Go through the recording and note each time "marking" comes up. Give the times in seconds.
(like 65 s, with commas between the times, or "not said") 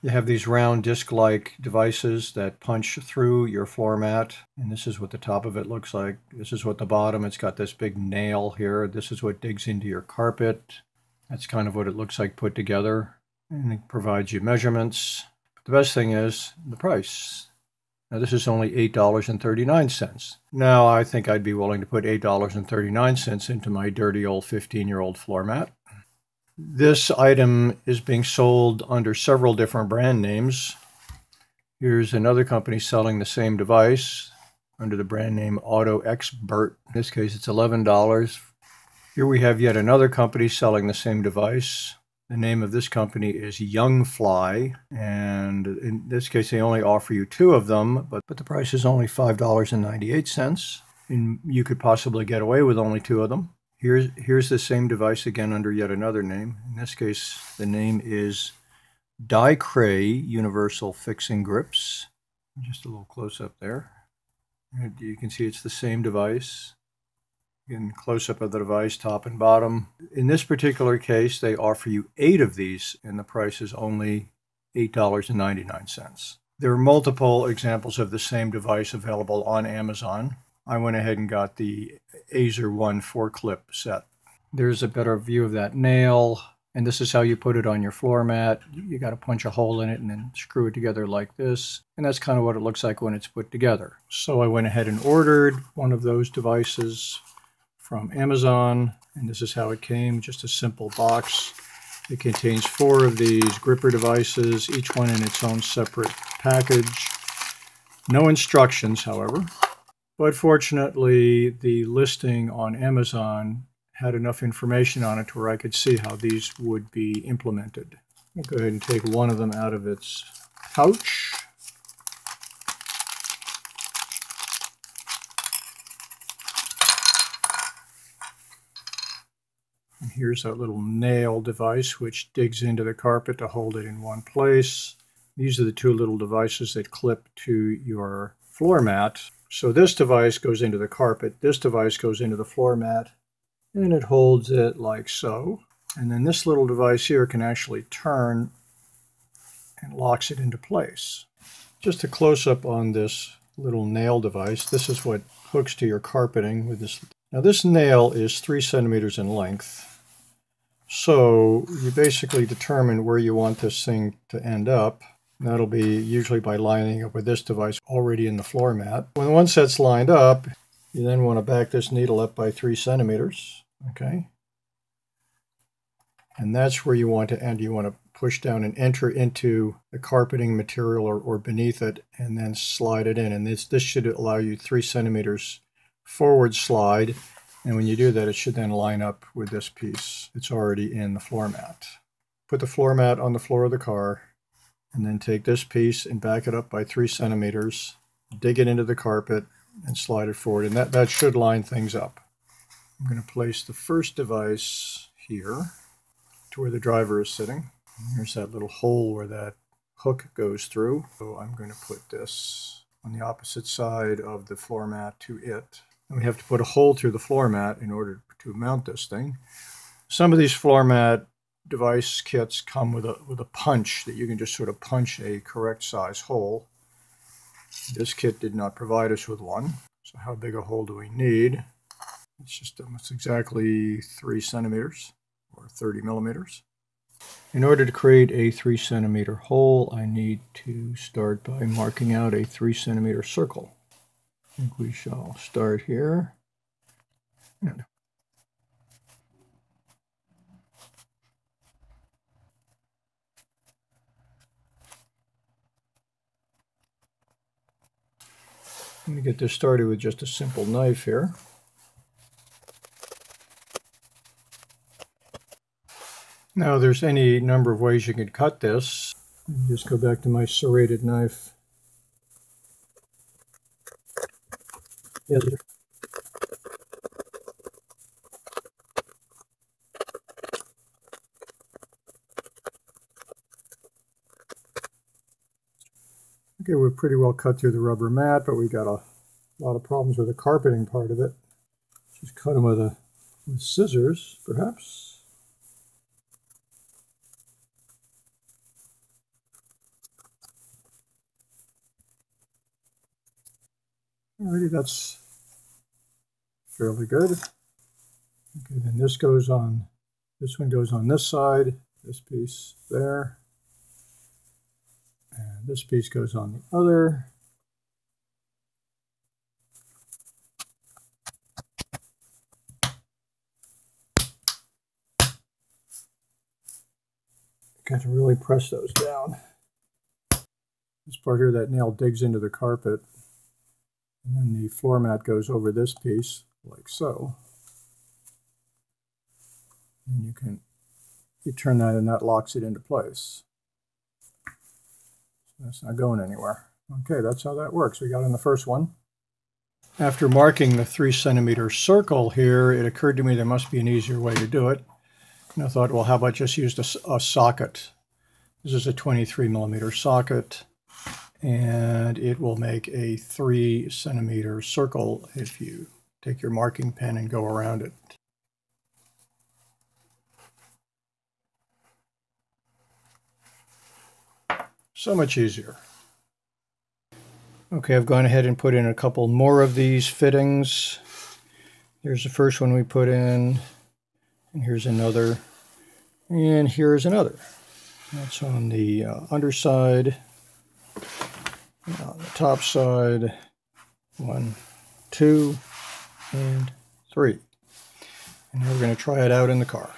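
241 s, 350 s, 366 s.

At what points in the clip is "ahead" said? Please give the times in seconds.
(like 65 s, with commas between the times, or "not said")
80 s, 94 s, 118 s, 378 s.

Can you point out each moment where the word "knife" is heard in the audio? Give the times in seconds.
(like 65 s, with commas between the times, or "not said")
260 s, 271 s.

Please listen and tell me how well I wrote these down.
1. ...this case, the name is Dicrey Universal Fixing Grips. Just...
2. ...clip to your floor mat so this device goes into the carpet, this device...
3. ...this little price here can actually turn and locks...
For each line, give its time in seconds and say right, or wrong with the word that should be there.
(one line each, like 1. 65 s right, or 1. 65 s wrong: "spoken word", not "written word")
1. 56 s right
2. 136 s right
3. 146 s wrong: "device", not "price".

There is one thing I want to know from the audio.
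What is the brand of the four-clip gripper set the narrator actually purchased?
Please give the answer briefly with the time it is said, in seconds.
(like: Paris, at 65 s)
Azerone, at 82 s.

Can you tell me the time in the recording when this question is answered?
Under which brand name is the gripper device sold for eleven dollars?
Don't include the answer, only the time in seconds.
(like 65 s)
35 s.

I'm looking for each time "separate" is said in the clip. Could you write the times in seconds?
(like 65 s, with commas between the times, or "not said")
105 s.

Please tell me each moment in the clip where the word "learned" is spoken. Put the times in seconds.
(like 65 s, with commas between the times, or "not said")
not said.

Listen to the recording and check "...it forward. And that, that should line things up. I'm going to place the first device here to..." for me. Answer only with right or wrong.
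right.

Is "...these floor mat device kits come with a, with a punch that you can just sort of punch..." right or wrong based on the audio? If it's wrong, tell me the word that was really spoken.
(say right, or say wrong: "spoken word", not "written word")
right.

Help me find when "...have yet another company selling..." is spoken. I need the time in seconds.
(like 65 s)
39 s.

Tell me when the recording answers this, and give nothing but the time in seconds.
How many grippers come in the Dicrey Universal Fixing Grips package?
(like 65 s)
72 s.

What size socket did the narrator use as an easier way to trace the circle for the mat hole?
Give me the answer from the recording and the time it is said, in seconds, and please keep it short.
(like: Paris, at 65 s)
23 millimeter, at 358 s.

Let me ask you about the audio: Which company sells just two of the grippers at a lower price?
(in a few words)
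Youngfly.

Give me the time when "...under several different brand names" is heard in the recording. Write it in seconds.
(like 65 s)
28 s.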